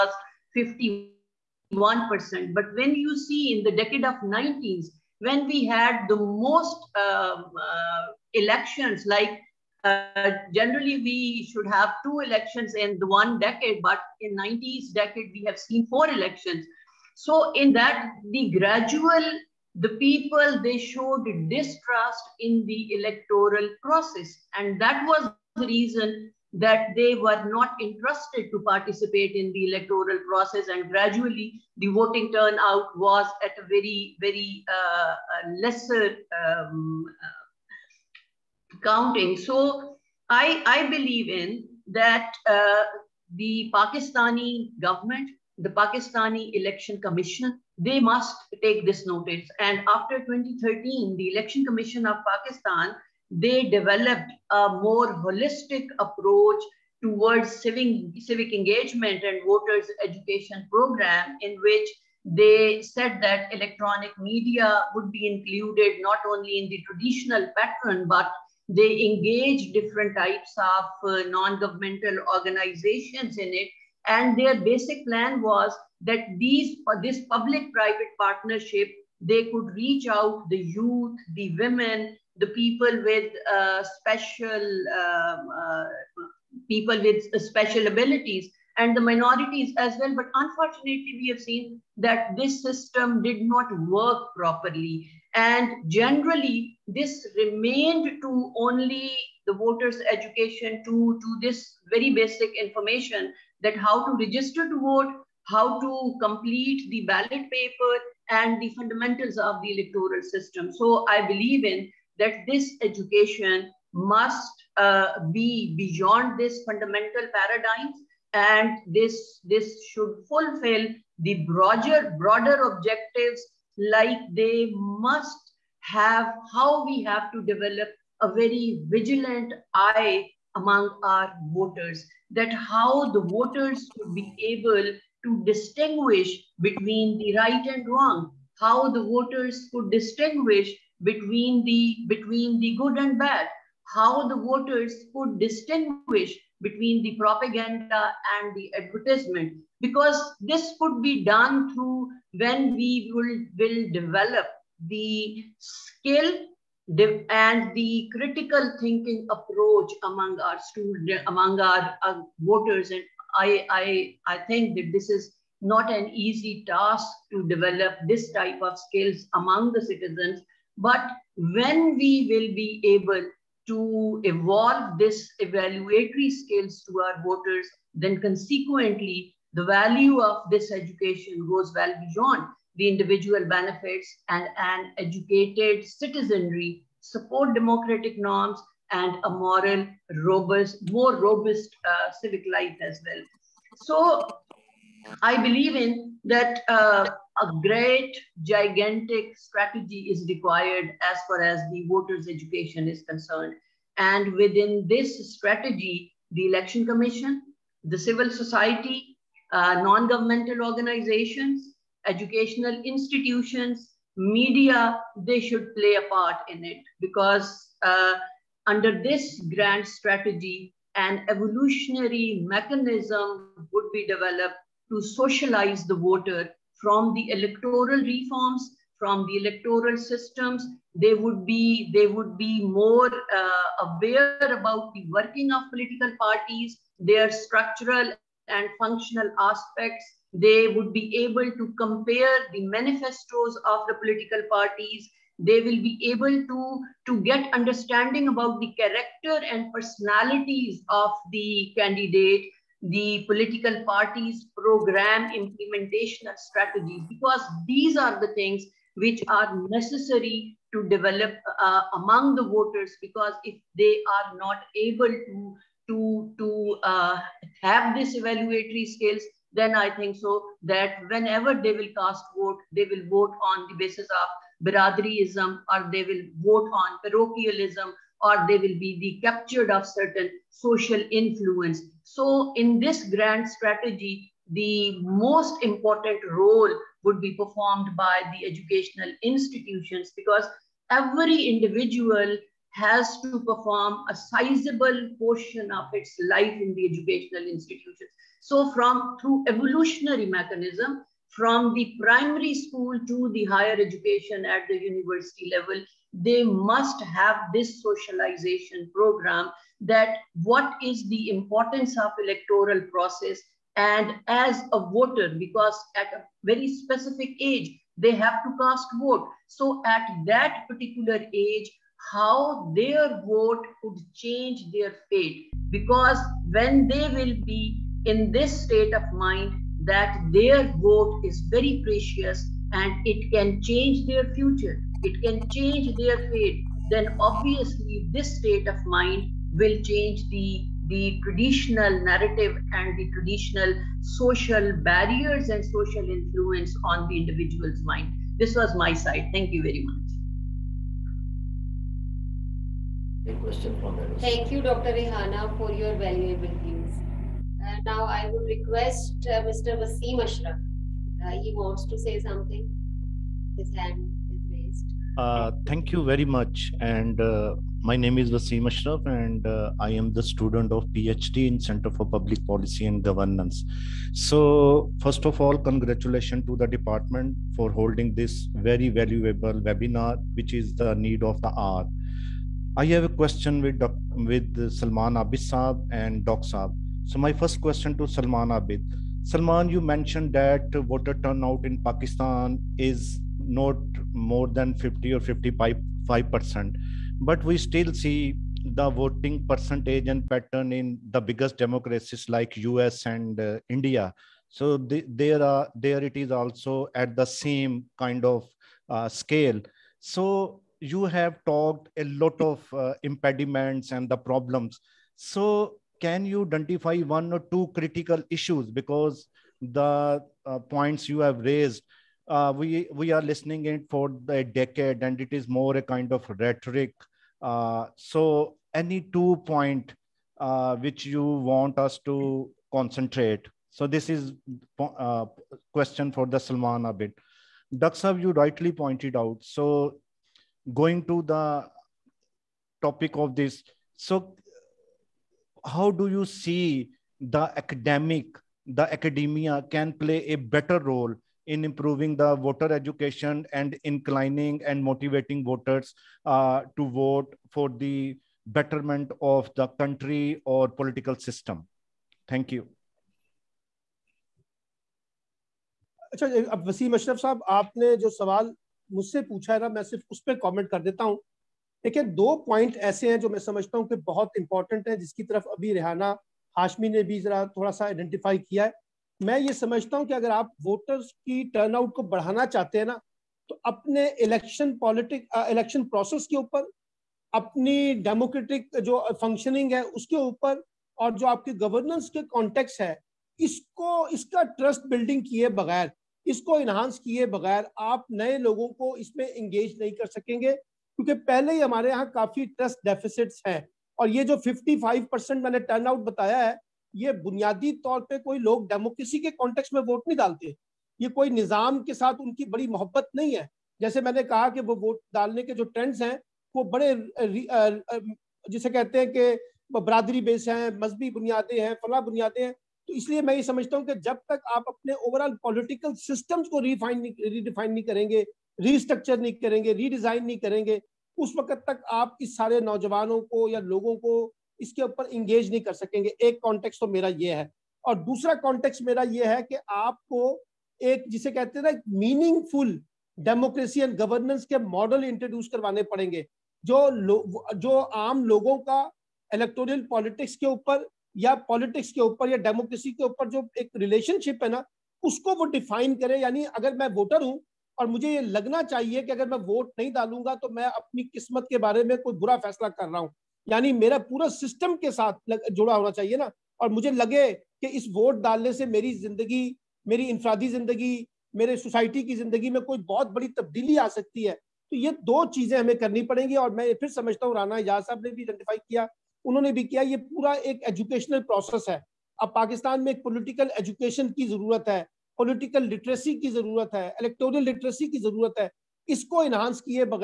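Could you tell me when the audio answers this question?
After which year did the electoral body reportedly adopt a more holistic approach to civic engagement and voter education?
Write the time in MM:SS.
00:49.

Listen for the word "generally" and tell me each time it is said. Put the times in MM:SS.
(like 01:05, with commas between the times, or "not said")
00:10, 01:35.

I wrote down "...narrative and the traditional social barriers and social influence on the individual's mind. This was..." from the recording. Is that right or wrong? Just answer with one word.
right.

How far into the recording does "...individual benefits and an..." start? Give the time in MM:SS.
03:02.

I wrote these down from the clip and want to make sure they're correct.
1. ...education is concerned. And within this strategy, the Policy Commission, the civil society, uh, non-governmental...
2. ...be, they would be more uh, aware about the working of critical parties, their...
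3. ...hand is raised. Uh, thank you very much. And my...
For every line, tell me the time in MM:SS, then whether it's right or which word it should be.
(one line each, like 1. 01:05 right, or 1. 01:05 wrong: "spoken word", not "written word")
1. 03:22 wrong: "Election", not "Policy"
2. 03:51 wrong: "political", not "critical"
3. 06:03 right.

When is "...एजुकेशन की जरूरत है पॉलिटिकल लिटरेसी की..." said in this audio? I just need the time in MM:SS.
09:43.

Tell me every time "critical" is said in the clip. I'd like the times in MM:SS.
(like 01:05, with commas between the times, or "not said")
02:38, 06:57.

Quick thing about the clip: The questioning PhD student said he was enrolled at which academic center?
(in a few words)
Center for Public Policy and Governance.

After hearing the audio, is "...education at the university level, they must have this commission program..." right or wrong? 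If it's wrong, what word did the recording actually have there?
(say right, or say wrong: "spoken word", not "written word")
wrong: "socialization", not "commission".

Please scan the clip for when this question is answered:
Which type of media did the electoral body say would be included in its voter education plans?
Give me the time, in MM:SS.
01:03.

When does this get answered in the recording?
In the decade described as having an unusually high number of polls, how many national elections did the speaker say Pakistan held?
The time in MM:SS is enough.
00:15.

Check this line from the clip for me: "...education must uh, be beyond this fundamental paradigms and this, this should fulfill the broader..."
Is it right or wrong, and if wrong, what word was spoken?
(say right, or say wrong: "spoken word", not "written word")
right.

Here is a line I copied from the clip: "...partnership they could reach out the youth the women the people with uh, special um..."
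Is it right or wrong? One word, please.
right.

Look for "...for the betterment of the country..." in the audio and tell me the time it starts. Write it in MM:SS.
07:37.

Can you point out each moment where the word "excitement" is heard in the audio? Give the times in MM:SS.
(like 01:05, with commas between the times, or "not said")
not said.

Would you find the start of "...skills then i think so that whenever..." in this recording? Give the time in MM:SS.
04:28.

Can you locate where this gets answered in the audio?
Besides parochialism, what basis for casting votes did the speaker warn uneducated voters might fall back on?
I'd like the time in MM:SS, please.
04:34.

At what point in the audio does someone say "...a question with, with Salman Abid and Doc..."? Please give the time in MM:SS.
06:23.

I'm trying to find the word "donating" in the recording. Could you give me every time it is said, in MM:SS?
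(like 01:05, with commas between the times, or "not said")
not said.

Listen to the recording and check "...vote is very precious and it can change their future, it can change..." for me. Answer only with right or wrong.
right.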